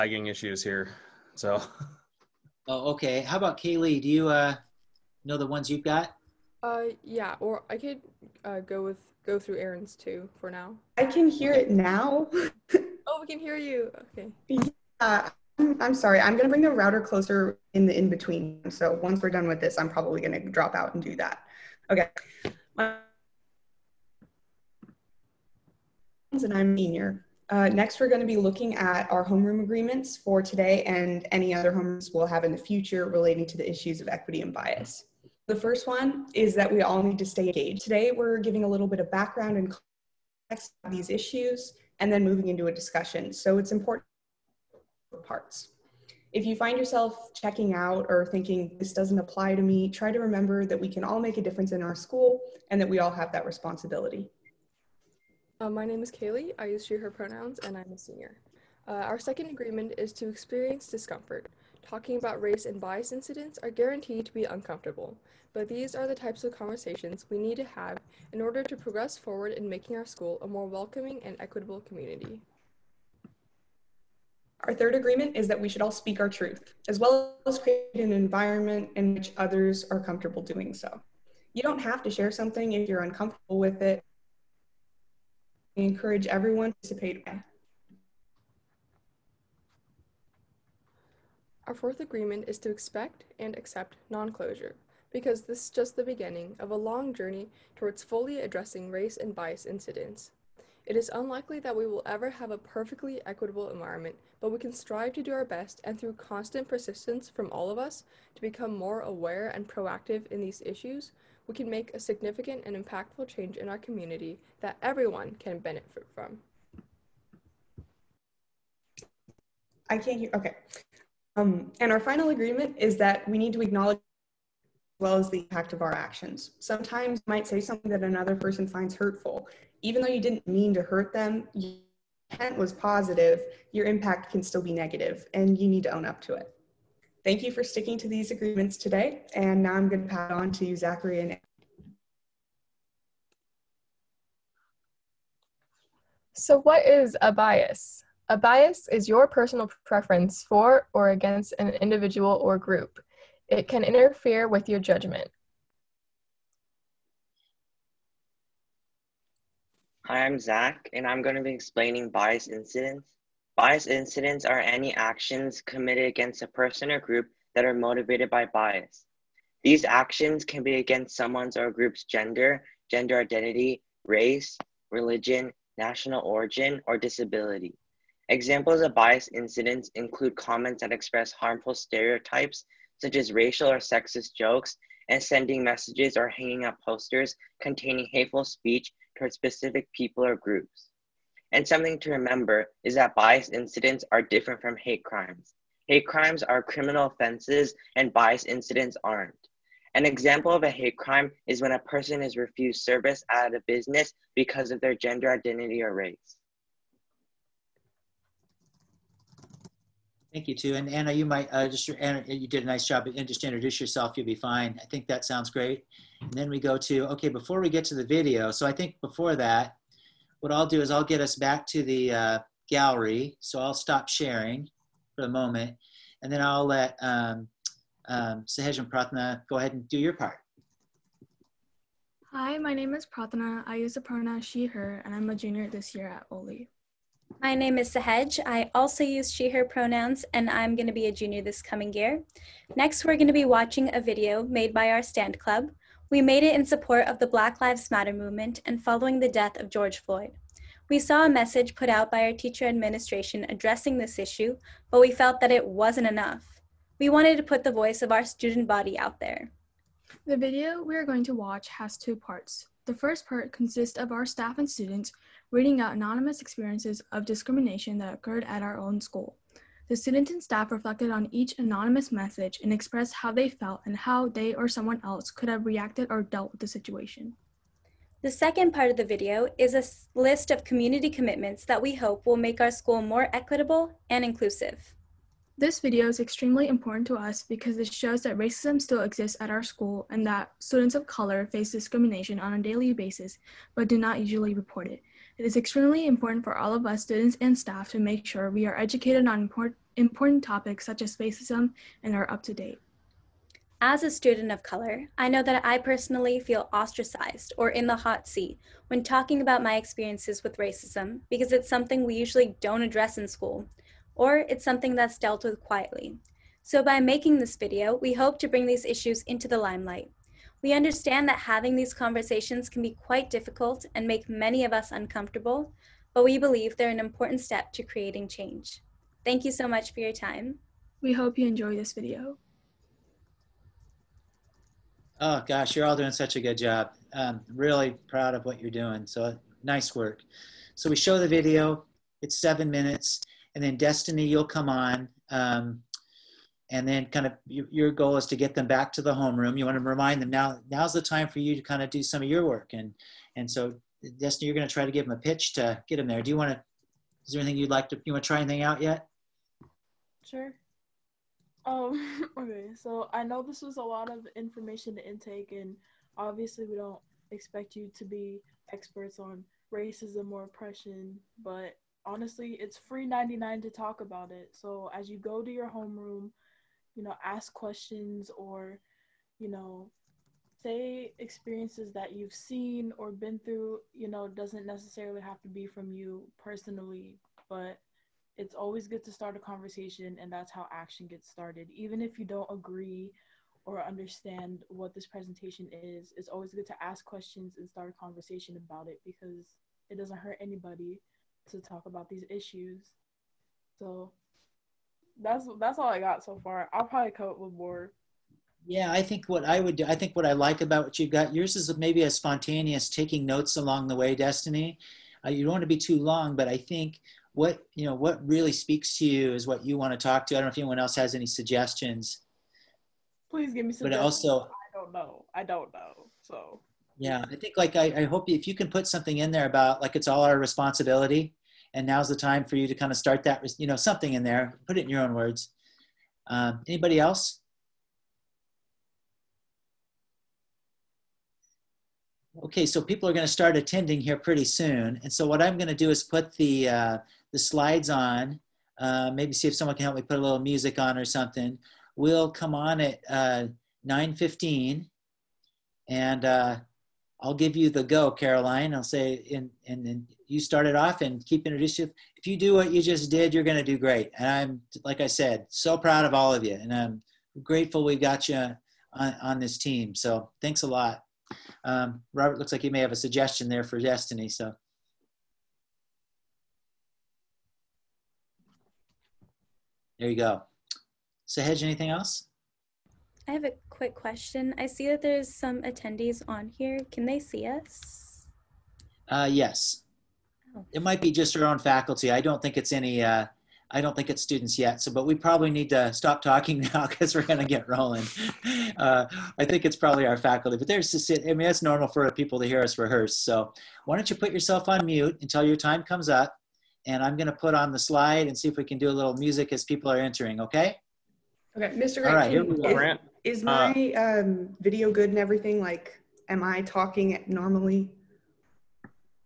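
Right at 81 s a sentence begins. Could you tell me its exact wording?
You don't have to share something if you're uncomfortable with it.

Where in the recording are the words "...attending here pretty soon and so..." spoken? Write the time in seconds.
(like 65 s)
443 s.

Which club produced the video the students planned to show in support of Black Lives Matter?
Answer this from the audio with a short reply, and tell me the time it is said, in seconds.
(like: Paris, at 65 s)
stand club, at 245 s.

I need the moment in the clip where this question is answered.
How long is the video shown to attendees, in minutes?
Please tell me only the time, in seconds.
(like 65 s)
342 s.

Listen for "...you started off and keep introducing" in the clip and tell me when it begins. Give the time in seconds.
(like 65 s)
460 s.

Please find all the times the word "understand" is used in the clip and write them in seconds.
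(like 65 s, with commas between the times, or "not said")
320 s, 393 s.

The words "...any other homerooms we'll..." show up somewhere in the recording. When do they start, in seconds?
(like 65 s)
31 s.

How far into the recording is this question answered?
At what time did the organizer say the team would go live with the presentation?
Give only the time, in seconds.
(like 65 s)
453 s.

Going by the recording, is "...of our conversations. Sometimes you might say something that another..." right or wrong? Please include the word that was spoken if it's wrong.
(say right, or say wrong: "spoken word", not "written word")
wrong: "actions", not "conversations".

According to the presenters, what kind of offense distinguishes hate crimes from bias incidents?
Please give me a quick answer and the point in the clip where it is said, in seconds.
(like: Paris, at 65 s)
criminal offenses, at 196 s.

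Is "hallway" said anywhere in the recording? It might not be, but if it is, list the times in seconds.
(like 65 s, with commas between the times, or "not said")
not said.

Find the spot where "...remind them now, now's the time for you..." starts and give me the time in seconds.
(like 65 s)
349 s.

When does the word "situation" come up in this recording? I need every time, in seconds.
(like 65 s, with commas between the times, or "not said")
276 s.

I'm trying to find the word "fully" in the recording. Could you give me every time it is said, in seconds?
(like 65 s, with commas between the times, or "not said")
98 s.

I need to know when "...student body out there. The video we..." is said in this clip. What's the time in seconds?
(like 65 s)
258 s.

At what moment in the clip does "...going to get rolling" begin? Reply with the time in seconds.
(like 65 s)
497 s.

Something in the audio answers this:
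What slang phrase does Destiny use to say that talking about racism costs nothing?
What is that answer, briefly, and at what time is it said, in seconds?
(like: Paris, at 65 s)
free 99, at 372 s.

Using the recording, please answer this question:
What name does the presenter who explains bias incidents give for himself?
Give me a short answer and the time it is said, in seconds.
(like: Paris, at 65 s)
Zach, at 160 s.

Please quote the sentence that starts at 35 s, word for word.
The first one is that we all need to stay engaged.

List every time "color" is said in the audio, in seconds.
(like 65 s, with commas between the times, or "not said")
291 s, 304 s.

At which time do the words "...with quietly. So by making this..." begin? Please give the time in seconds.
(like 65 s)
315 s.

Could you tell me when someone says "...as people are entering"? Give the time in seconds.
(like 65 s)
509 s.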